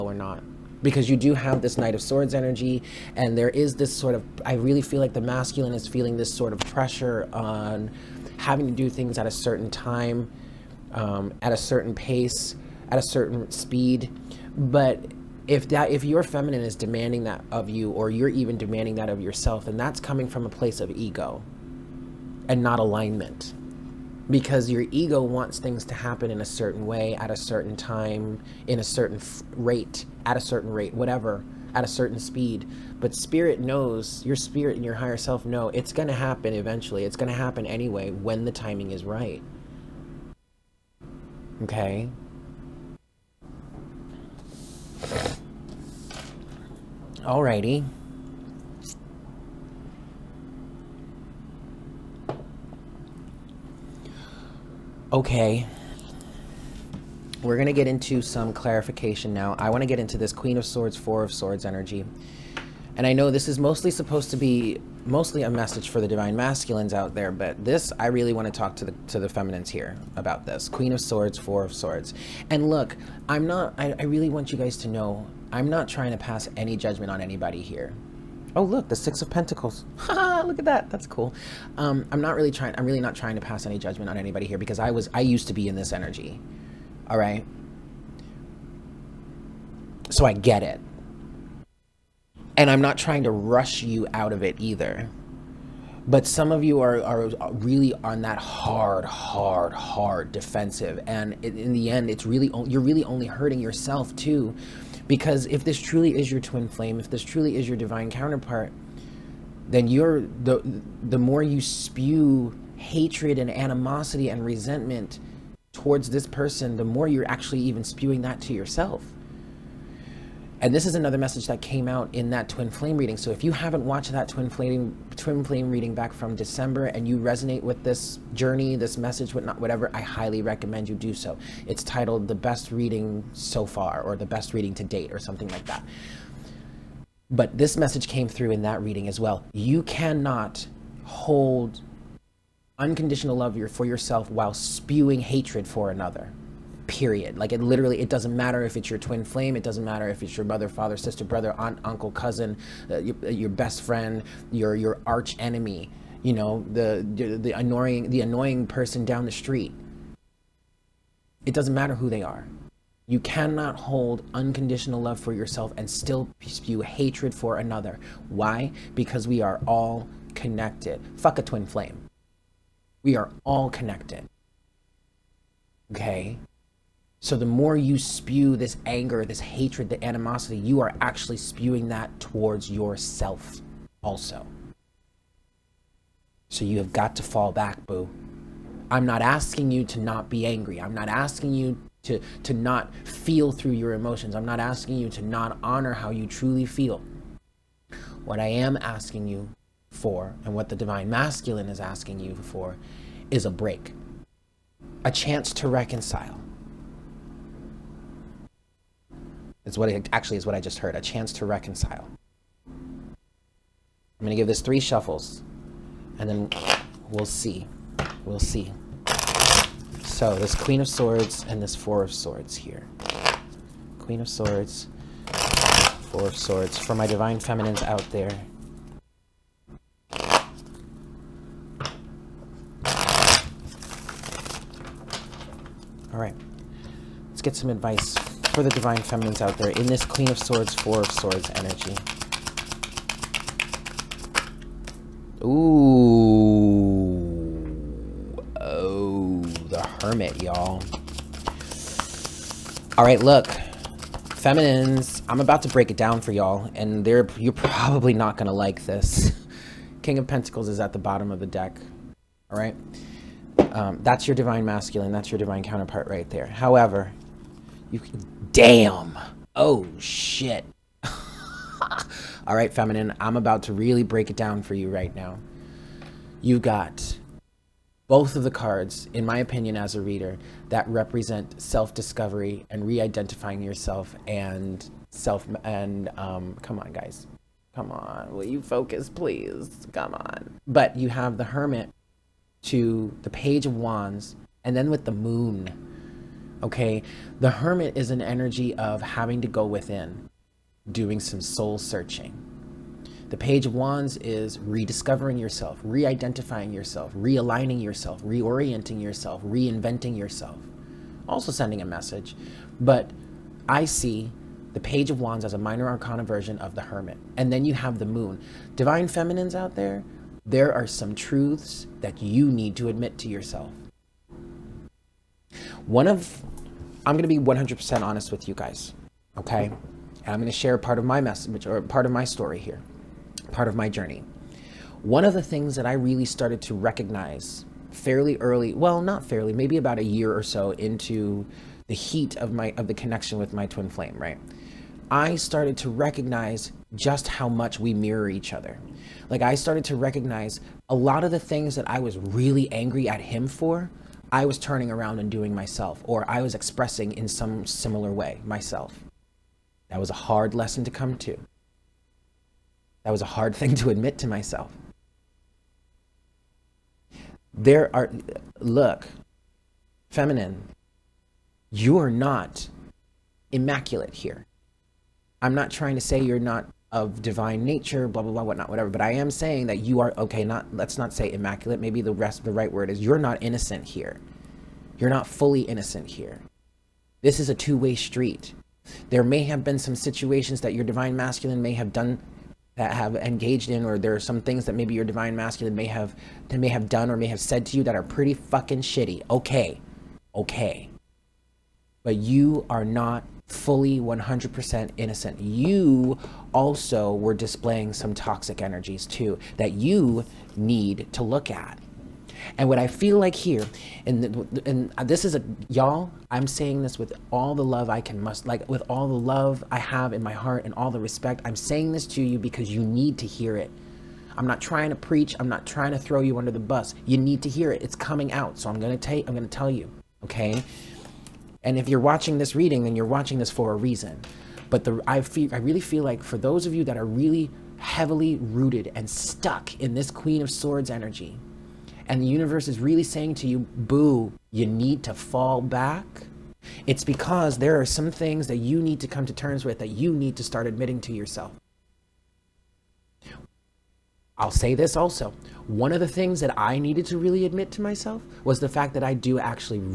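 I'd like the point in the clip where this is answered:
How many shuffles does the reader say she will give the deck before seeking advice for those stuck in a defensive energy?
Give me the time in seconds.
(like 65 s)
214 s.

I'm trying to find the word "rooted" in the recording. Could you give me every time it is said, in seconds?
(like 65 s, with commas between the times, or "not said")
438 s.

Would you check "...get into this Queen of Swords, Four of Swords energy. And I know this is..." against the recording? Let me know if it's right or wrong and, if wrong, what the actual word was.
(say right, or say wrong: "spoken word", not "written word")
right.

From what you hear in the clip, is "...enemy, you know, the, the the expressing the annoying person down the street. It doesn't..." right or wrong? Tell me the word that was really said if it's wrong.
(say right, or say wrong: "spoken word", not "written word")
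wrong: "annoying", not "expressing".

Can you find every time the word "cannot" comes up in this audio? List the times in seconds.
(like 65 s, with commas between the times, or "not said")
139 s, 163 s.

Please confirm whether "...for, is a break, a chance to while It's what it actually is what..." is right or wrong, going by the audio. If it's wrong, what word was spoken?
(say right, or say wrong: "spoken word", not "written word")
wrong: "reconcile", not "while".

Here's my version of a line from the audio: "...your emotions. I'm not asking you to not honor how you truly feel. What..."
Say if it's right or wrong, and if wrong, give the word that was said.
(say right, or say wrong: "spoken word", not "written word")
right.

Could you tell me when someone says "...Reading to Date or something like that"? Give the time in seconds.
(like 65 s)
134 s.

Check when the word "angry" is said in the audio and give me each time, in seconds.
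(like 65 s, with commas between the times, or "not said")
190 s, 352 s.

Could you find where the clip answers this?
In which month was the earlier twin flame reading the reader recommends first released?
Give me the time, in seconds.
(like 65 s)
126 s.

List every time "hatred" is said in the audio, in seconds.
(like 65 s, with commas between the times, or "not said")
112 s, 145 s, 166 s, 179 s.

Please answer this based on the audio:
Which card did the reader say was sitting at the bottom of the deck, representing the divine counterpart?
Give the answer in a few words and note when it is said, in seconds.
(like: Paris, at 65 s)
King of Pentacles, at 260 s.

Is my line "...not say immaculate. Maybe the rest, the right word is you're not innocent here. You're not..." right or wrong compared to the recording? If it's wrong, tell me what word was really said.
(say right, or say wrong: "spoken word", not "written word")
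right.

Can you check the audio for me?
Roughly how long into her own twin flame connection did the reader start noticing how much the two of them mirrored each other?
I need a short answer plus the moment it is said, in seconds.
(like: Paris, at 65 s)
About a year, at 339 s.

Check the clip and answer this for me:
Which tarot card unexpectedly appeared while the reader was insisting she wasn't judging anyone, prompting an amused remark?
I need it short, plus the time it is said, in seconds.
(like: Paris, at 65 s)
Six of Pentacles, at 78 s.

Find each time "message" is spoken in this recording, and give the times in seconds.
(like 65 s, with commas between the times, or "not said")
65 s, 121 s, 128 s, 137 s, 311 s, 331 s.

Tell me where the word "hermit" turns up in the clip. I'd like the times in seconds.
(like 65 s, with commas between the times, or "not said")
250 s, 291 s, 297 s, 316 s.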